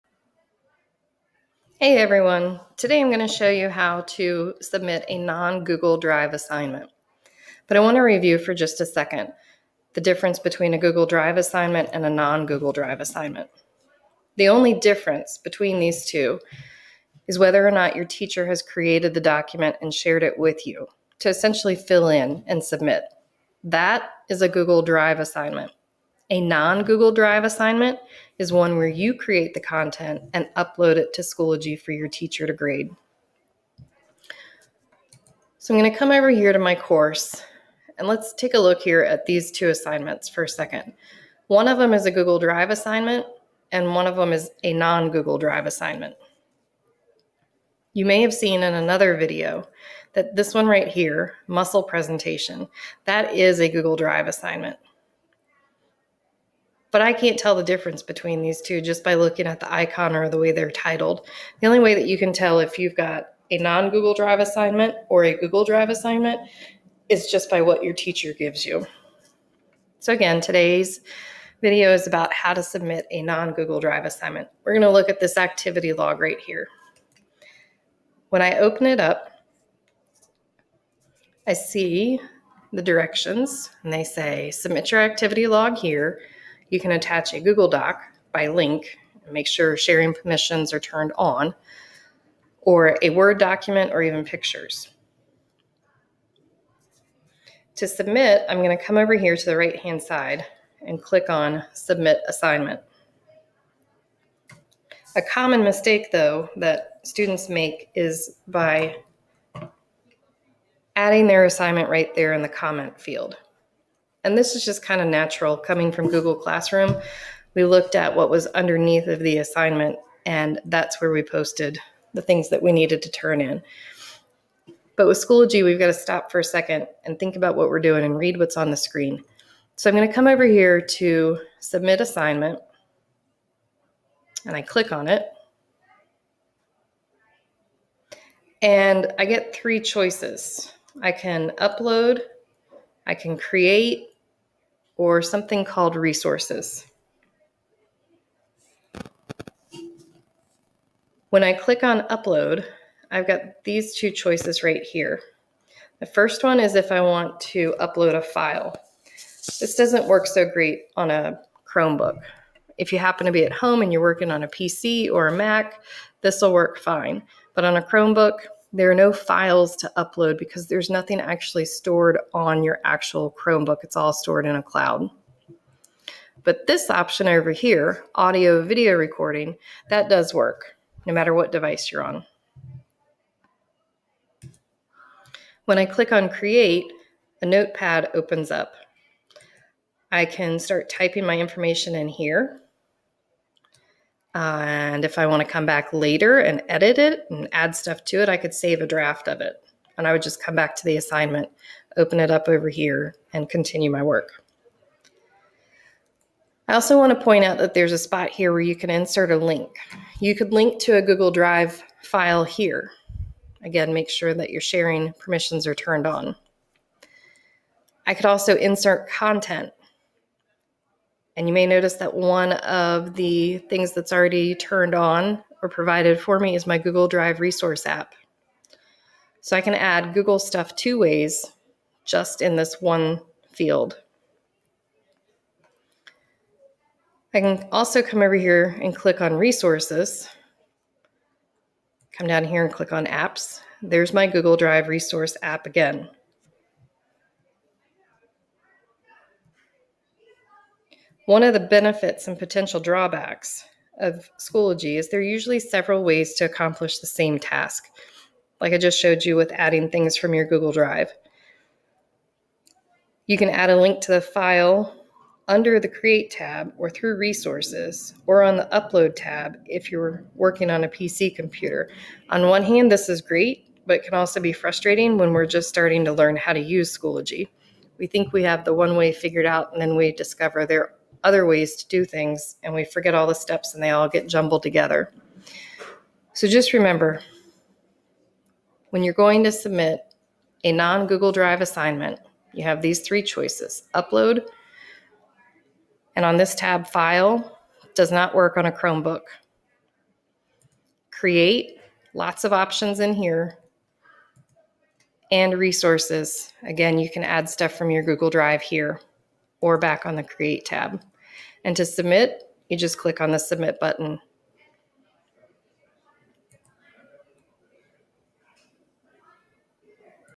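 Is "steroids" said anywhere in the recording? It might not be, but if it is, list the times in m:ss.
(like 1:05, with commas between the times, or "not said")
not said.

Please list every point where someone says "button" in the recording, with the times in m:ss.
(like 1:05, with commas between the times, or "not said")
5:13.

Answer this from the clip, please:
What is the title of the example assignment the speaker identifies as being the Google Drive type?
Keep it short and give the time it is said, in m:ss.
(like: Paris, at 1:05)
Muscle presentation, at 0:51.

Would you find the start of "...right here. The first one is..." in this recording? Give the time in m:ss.
2:34.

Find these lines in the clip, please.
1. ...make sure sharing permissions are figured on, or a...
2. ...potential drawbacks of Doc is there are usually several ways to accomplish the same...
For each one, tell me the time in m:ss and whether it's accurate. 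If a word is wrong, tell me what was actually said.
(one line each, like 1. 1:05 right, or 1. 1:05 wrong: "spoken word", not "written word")
1. 1:29 wrong: "turned", not "figured"
2. 4:12 wrong: "Schoology", not "Doc".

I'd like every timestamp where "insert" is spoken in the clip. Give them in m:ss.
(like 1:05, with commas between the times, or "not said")
3:28, 3:38.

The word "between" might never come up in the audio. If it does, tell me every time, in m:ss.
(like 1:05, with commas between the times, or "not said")
0:10, 0:15, 0:58.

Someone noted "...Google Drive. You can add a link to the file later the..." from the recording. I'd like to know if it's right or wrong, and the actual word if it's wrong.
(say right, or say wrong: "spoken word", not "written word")
wrong: "under", not "later".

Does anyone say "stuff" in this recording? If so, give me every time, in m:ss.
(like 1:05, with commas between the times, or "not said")
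3:17, 3:50, 5:07.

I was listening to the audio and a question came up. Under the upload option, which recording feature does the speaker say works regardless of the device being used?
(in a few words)
Audio video recording.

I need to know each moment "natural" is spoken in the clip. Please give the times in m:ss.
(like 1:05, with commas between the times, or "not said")
1:55.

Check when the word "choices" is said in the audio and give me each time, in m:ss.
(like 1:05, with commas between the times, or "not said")
2:19, 2:34, 4:53.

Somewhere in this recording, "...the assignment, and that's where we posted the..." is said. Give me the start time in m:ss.
1:59.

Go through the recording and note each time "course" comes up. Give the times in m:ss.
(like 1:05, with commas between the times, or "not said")
0:36.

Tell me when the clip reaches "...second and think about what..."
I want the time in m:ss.
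2:06.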